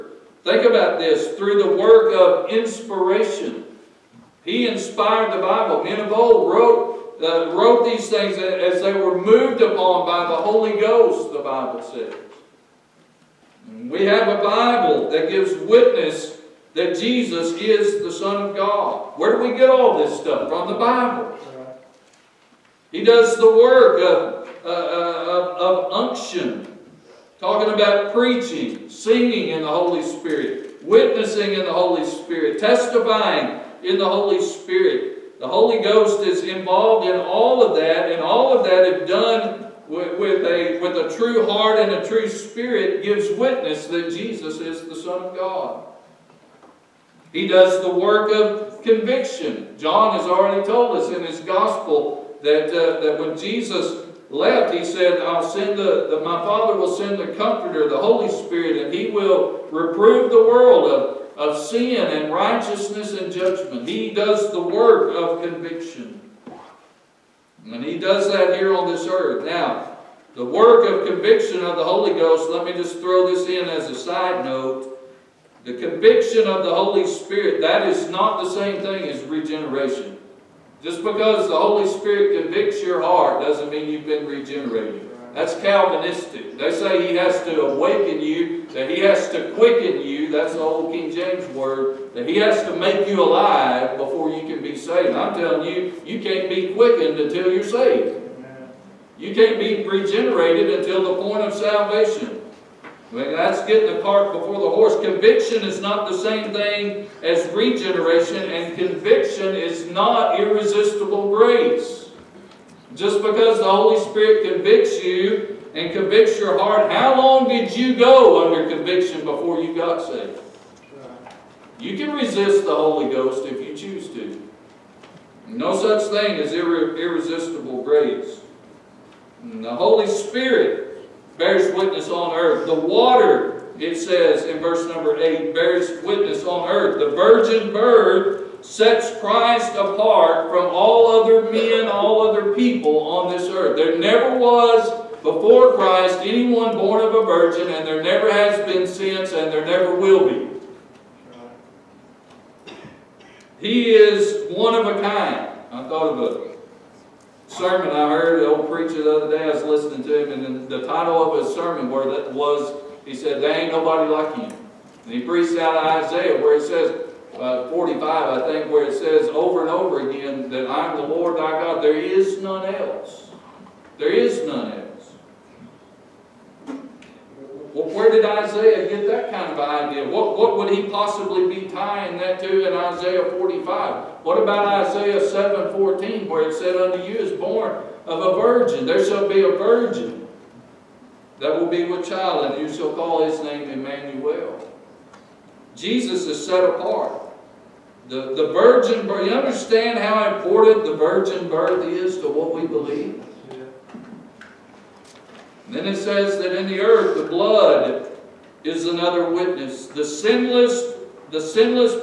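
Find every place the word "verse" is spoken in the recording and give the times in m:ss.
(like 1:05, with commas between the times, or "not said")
2:14.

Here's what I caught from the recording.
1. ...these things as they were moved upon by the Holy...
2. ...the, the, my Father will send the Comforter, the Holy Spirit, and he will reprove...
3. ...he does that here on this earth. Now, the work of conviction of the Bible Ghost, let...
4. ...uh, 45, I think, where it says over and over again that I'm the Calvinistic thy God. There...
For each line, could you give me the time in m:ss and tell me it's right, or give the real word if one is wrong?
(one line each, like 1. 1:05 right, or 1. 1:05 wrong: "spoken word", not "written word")
1. 0:07 right
2. 0:55 right
3. 1:07 wrong: "Holy", not "Bible"
4. 2:47 wrong: "Lord", not "Calvinistic".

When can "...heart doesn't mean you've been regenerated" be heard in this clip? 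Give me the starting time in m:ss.
1:23.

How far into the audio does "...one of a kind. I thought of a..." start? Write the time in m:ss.
2:34.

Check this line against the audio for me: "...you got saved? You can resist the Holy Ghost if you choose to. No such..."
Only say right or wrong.
right.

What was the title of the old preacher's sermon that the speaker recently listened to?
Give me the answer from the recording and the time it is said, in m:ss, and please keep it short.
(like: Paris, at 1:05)
There ain't nobody like you, at 2:43.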